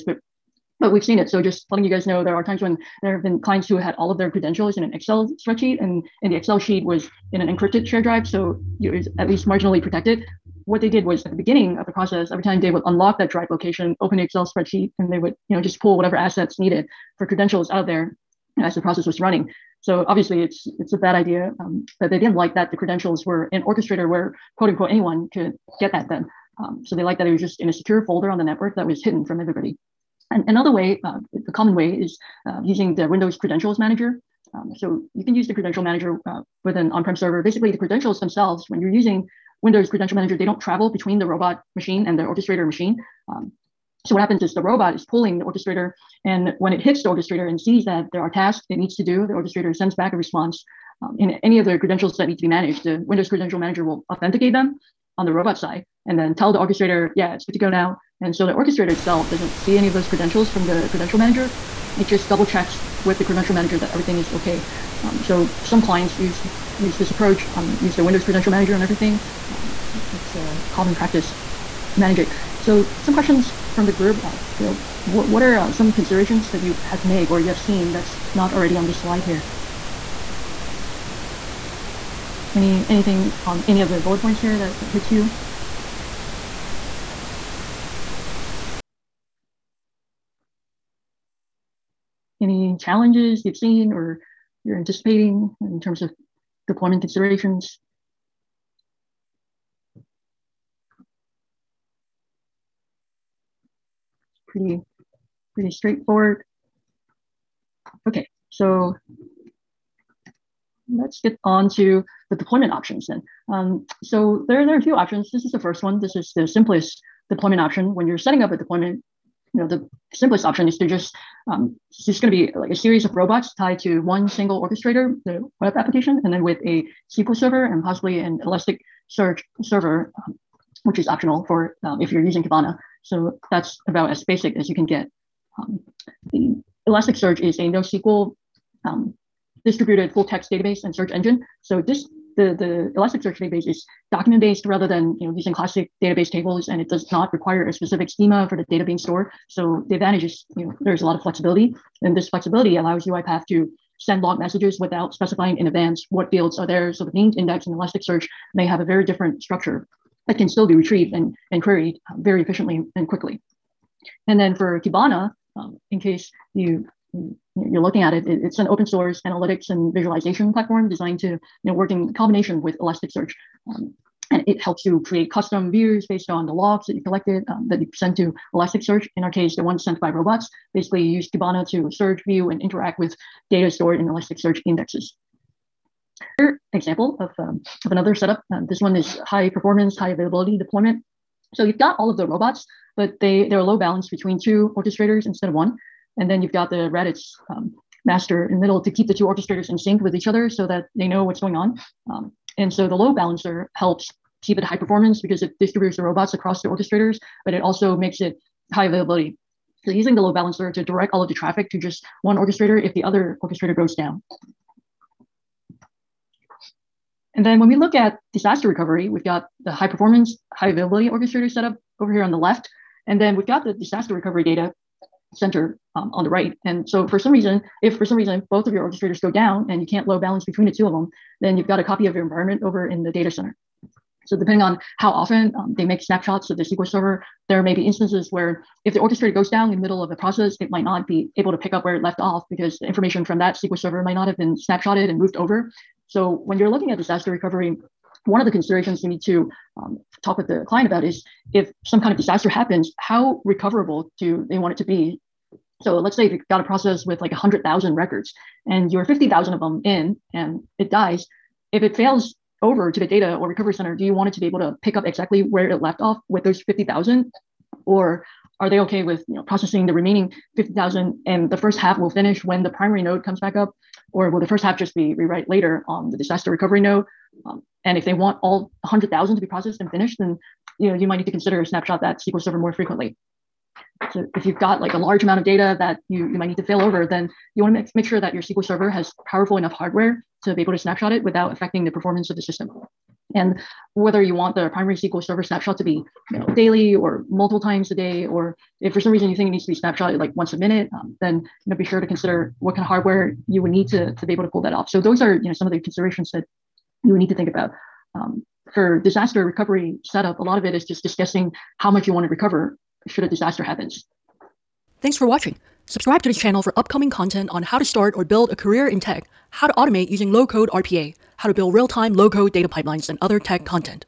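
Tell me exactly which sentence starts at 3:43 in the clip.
And then we've got the disaster recovery data center um, on the right.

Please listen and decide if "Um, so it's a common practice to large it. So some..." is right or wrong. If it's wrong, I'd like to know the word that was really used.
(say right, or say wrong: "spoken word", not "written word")
wrong: "manage", not "large".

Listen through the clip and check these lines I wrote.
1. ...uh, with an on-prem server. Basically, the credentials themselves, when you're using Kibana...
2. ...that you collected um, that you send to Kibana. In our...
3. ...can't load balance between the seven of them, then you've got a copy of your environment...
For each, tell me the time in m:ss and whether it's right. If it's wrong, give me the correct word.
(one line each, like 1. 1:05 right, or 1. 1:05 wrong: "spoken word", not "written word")
1. 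0:36 wrong: "Windows", not "Kibana"
2. 2:56 wrong: "Elasticsearch", not "Kibana"
3. 3:49 wrong: "two", not "seven".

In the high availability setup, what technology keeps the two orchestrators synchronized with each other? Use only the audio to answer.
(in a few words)
Redis.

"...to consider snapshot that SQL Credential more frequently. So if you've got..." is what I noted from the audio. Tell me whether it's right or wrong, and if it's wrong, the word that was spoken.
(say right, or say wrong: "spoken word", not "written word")
wrong: "Server", not "Credential".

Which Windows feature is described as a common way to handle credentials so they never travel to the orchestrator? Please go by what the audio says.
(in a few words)
Windows Credentials Manager.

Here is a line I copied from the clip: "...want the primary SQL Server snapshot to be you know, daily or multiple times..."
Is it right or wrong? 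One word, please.
right.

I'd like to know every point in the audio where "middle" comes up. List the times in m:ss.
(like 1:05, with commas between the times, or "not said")
3:18, 3:59.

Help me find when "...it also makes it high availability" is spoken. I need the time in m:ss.
3:27.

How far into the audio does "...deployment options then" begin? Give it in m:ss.
1:52.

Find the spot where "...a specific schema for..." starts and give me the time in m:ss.
2:27.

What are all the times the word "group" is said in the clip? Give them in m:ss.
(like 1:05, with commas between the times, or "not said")
1:13.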